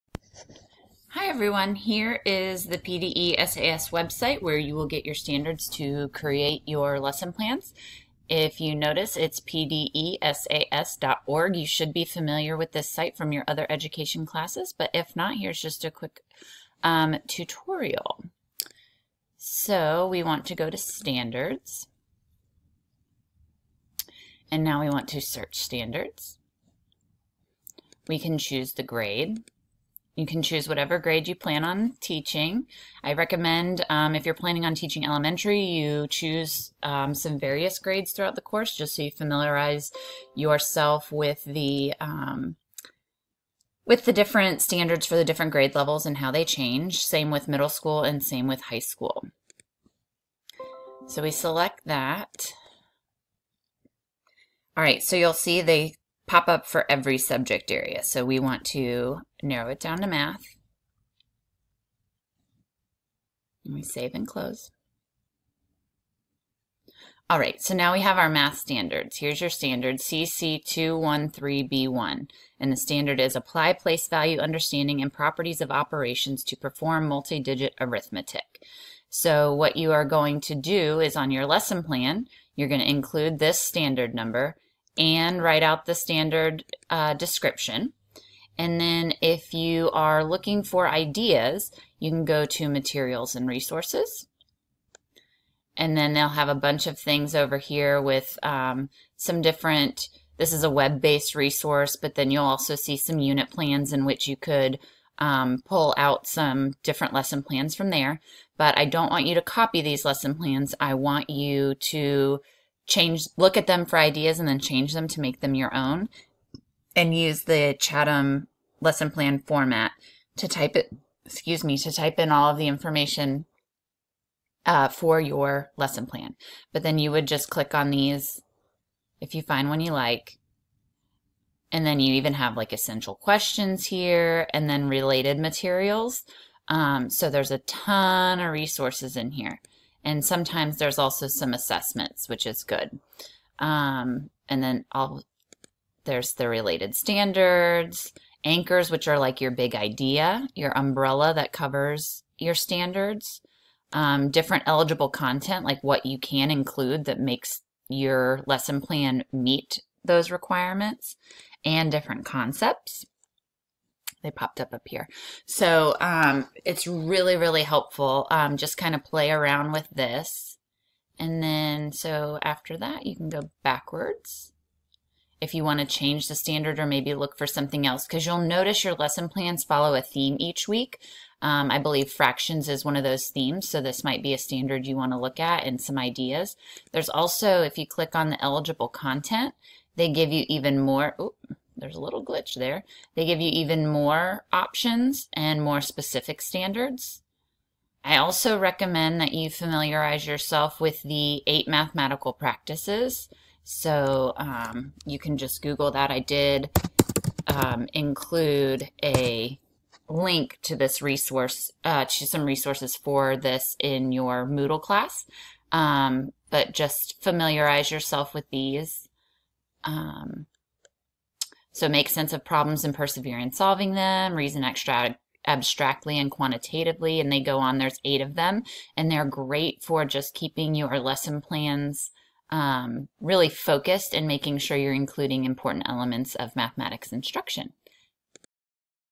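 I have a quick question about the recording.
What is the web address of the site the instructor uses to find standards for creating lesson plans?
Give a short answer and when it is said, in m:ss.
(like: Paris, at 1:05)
pdesas.org, at 0:09.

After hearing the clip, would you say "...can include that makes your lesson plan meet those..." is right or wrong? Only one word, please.
right.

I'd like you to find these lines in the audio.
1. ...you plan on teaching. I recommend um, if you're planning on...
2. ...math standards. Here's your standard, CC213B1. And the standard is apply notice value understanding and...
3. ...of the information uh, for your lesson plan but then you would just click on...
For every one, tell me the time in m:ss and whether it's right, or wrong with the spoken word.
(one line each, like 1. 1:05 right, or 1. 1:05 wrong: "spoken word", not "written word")
1. 0:31 right
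2. 1:08 wrong: "place", not "notice"
3. 2:02 right.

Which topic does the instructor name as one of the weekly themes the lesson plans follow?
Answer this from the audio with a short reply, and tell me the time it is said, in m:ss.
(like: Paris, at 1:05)
Fractions, at 3:02.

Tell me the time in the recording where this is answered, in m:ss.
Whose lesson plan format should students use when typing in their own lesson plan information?
1:57.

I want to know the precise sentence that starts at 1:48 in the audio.
But I don't want you to copy these lesson plans.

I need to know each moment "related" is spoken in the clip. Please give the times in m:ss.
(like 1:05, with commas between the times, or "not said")
2:14, 2:26.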